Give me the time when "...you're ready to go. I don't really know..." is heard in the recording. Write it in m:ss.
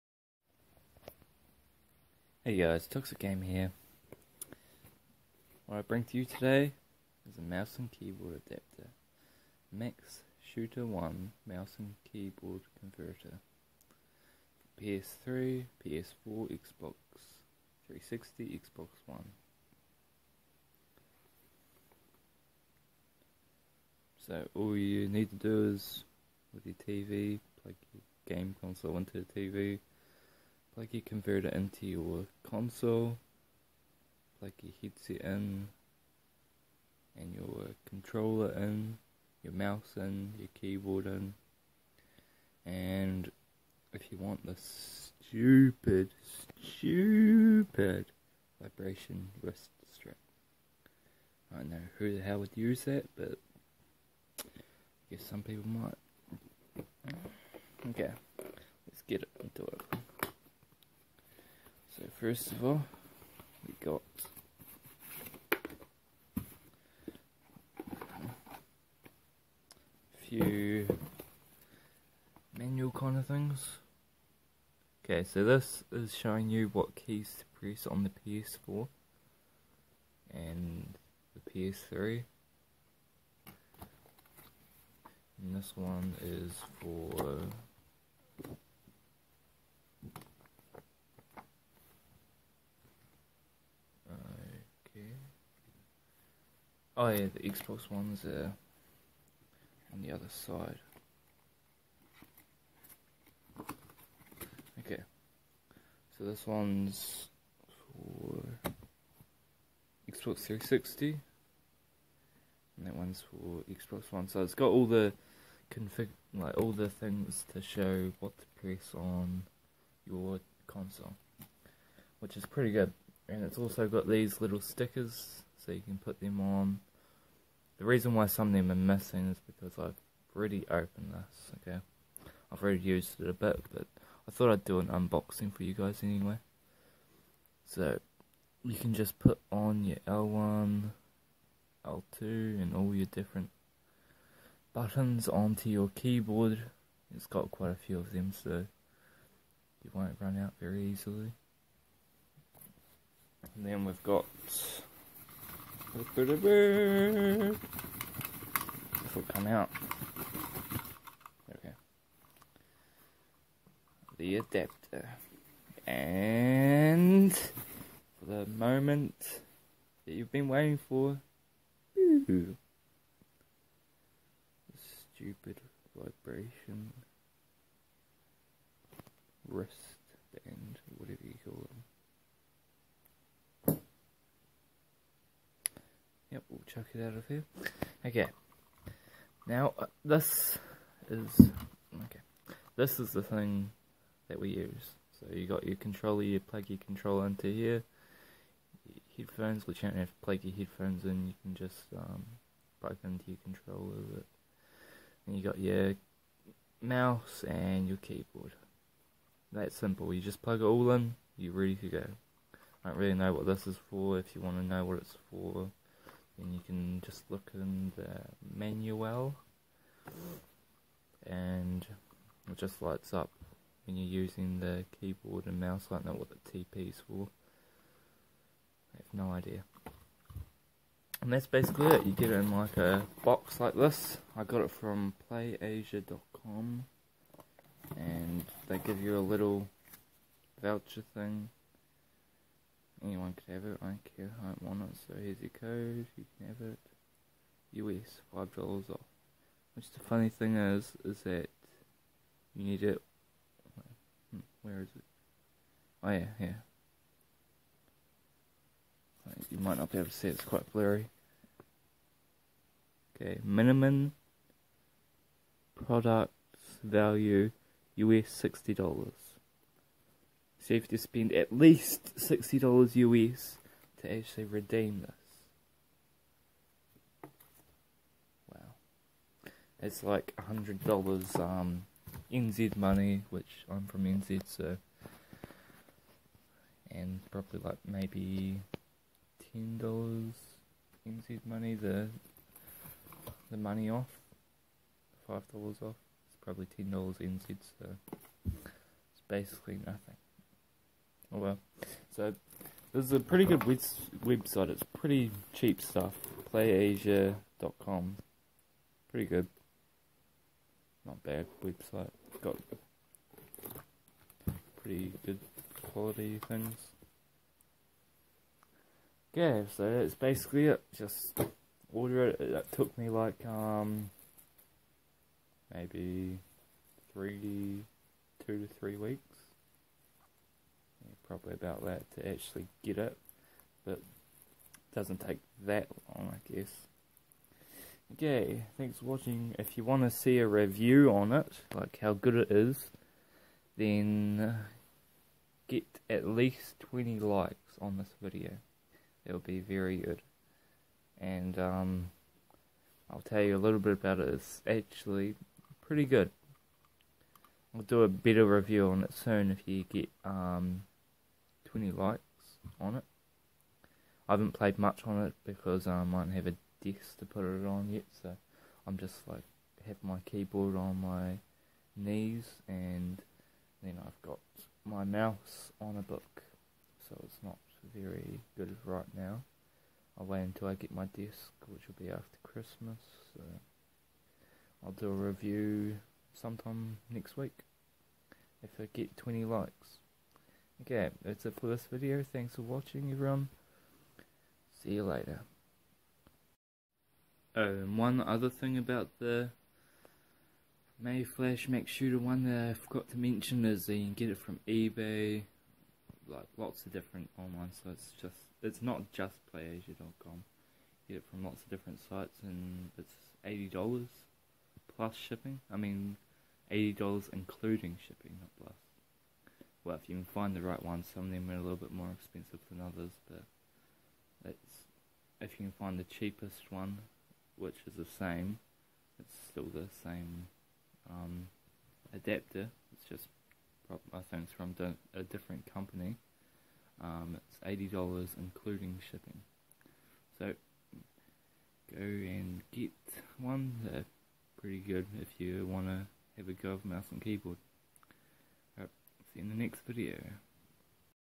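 3:31.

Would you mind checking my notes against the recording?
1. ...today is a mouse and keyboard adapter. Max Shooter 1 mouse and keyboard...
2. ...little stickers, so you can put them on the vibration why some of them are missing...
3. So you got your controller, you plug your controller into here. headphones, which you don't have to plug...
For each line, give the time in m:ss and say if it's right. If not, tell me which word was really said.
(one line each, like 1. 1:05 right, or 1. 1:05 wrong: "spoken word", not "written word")
1. 0:06 right
2. 2:04 wrong: "reason", not "vibration"
3. 3:15 right.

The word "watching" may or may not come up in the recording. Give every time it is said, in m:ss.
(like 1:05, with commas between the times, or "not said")
5:39, 6:32.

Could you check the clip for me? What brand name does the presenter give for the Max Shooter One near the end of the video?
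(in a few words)
Mayflash.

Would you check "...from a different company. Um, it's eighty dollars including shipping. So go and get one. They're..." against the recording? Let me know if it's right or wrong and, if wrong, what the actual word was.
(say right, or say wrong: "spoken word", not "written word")
right.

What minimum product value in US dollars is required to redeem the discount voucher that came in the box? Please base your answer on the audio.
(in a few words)
$60.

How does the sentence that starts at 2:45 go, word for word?
And for the moment that you've been waiting for.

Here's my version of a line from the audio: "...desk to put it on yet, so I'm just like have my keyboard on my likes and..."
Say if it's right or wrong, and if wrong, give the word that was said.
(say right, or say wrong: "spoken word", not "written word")
wrong: "knees", not "likes".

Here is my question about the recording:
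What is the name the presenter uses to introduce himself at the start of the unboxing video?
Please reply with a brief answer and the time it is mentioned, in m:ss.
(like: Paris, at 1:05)
Toxic Game, at 0:02.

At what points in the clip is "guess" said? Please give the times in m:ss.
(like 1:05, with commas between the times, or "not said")
0:55, 5:36.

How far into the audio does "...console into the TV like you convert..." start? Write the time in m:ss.
0:28.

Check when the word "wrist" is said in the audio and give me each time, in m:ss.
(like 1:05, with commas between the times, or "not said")
0:49, 2:59.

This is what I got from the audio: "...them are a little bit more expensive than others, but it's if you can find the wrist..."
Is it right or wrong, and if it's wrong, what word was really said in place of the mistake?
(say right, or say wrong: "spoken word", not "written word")
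wrong: "cheapest", not "wrist".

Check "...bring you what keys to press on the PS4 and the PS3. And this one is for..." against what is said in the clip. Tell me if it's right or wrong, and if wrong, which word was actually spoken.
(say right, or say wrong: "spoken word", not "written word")
wrong: "showing", not "bring".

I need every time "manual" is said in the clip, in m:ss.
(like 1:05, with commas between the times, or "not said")
1:12, 3:38.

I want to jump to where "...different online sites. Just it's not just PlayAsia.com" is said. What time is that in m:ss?
6:46.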